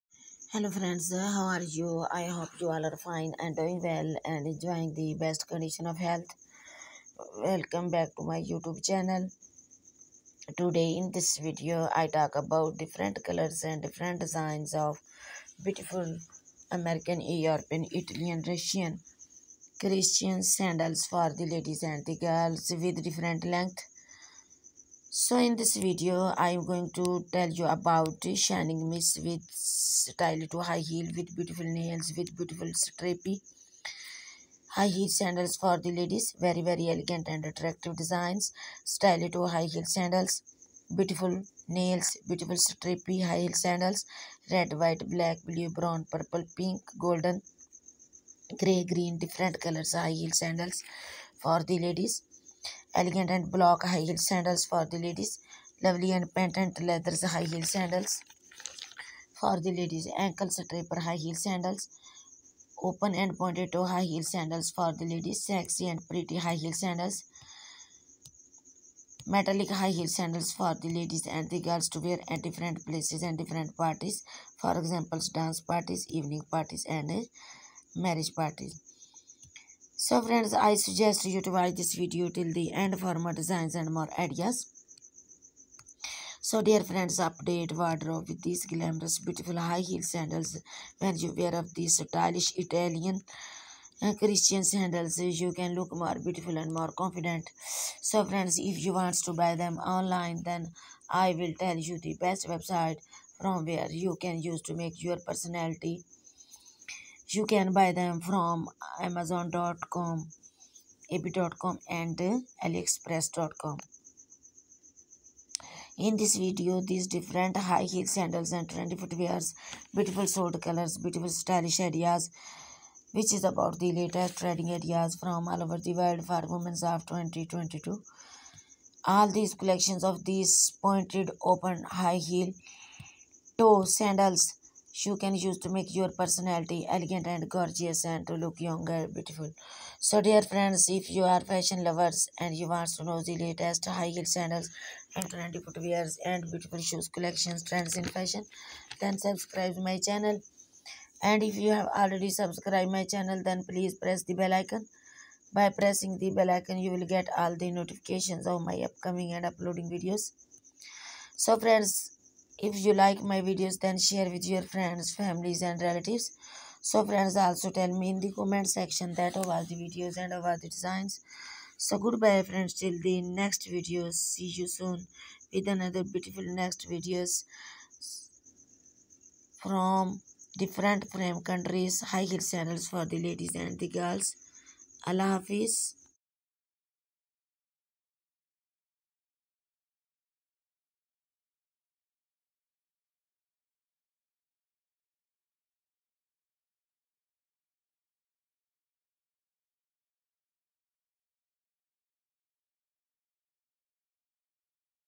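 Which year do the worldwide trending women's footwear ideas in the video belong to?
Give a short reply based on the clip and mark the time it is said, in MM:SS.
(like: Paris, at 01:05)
2022, at 02:07.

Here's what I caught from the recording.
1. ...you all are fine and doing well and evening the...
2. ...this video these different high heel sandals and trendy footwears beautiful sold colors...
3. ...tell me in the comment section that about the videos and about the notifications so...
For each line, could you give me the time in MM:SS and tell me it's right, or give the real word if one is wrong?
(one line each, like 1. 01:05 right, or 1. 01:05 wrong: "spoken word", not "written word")
1. 00:02 wrong: "enjoying", not "evening"
2. 01:56 right
3. 02:47 wrong: "designs", not "notifications".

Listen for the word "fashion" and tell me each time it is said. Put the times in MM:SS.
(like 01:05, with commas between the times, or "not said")
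02:21, 02:28.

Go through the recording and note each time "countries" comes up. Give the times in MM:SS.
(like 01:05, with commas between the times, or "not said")
03:01.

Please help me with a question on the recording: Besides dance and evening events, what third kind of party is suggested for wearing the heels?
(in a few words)
Marriage parties.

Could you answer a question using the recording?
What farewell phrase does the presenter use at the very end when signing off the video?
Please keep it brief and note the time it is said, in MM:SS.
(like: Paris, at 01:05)
Allah Hafiz, at 03:05.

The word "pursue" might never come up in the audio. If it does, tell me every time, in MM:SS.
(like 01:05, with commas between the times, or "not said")
not said.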